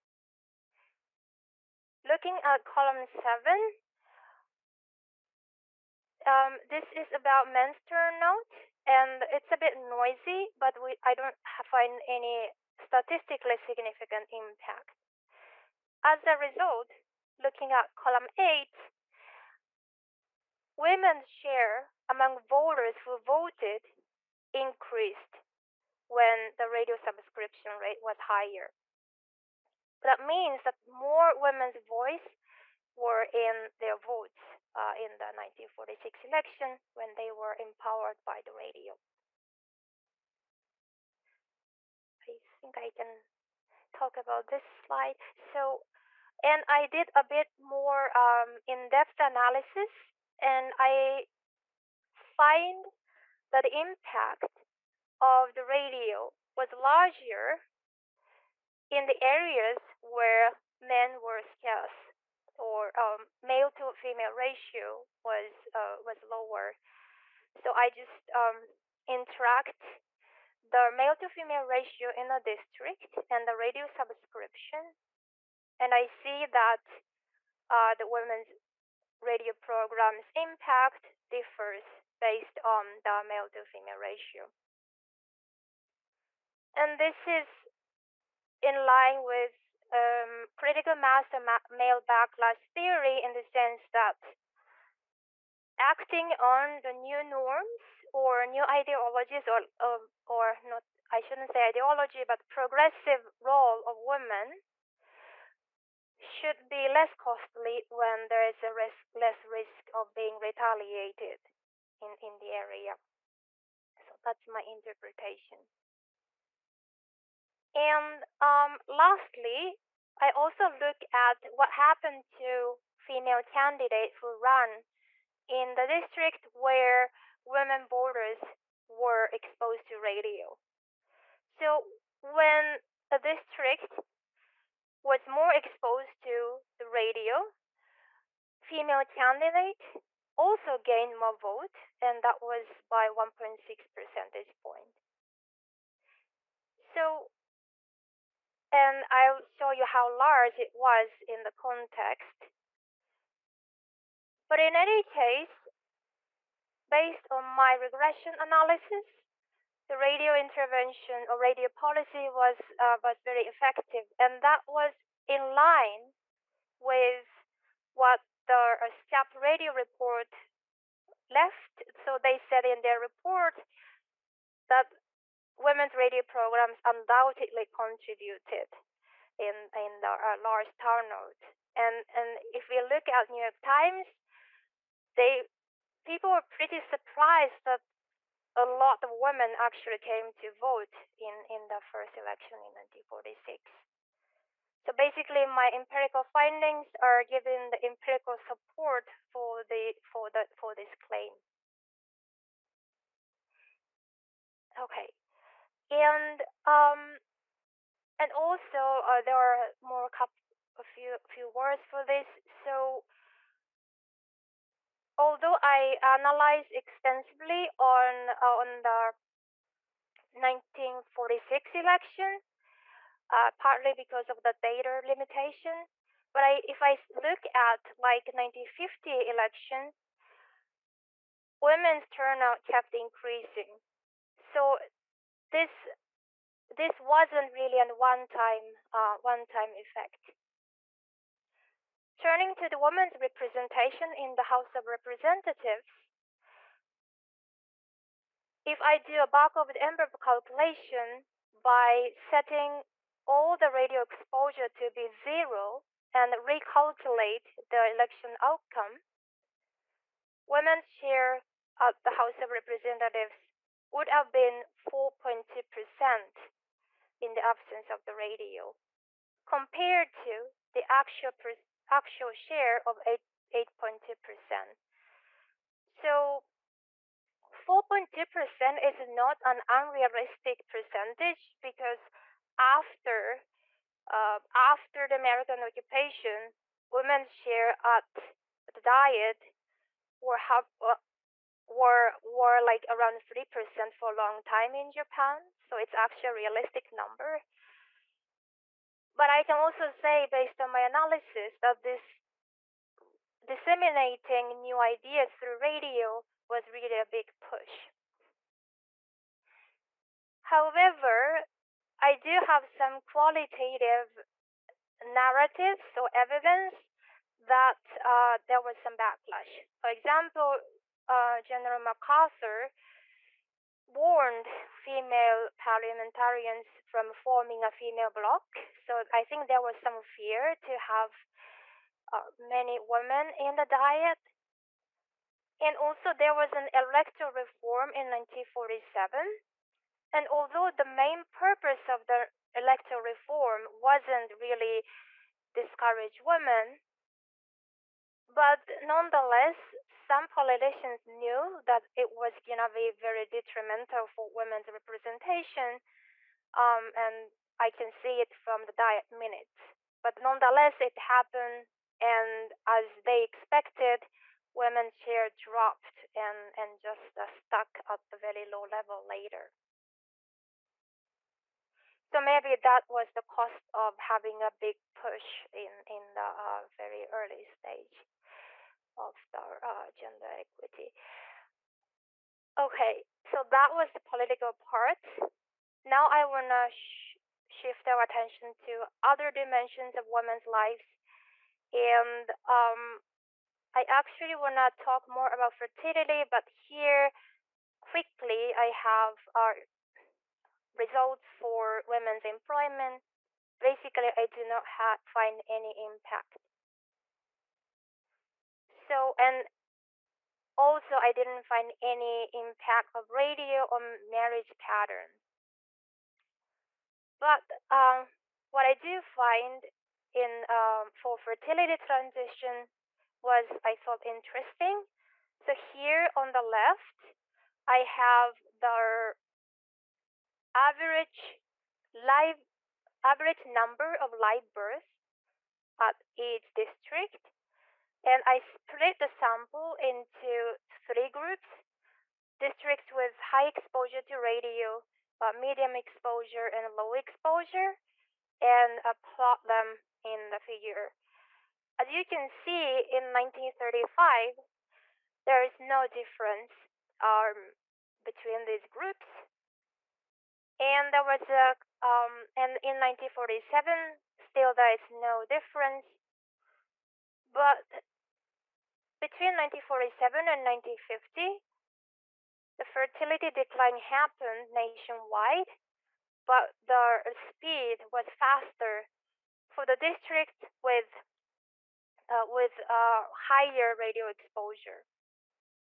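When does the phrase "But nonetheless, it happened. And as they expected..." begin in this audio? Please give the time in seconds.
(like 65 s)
360 s.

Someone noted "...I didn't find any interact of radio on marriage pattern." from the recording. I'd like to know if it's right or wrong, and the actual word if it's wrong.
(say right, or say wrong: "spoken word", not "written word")
wrong: "impact", not "interact".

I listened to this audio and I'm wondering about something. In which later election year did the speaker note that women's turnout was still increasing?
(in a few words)
1950.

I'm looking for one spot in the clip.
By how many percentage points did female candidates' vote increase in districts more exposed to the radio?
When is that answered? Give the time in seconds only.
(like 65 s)
143 s.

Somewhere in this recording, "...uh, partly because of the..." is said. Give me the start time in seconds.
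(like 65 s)
223 s.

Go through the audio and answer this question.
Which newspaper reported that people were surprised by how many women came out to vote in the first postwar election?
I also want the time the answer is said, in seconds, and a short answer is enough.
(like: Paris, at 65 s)
New York Times, at 183 s.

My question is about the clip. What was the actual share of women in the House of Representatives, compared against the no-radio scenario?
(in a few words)
8.2%.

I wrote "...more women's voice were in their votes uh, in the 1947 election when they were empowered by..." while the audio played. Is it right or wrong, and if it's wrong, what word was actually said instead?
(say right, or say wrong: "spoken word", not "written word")
wrong: "1946", not "1947".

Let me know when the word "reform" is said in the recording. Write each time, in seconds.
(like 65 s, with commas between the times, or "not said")
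337 s, 343 s.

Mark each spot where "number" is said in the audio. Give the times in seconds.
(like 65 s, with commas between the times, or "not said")
296 s, 433 s.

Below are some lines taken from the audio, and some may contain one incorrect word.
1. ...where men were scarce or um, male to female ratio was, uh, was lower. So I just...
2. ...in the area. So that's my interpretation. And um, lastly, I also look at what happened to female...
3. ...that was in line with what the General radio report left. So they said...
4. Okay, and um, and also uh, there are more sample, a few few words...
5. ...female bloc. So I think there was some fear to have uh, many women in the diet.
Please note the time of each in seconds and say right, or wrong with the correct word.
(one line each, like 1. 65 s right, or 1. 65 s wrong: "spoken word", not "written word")
1. 60 s right
2. 112 s right
3. 164 s wrong: "SCAP", not "General"
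4. 204 s wrong: "couple", not "sample"
5. 327 s right.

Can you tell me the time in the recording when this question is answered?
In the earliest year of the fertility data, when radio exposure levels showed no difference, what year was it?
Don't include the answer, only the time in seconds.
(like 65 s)
453 s.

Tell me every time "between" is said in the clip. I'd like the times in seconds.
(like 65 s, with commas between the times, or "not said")
458 s, 469 s.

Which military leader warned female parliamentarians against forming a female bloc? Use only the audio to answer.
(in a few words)
General MacArthur.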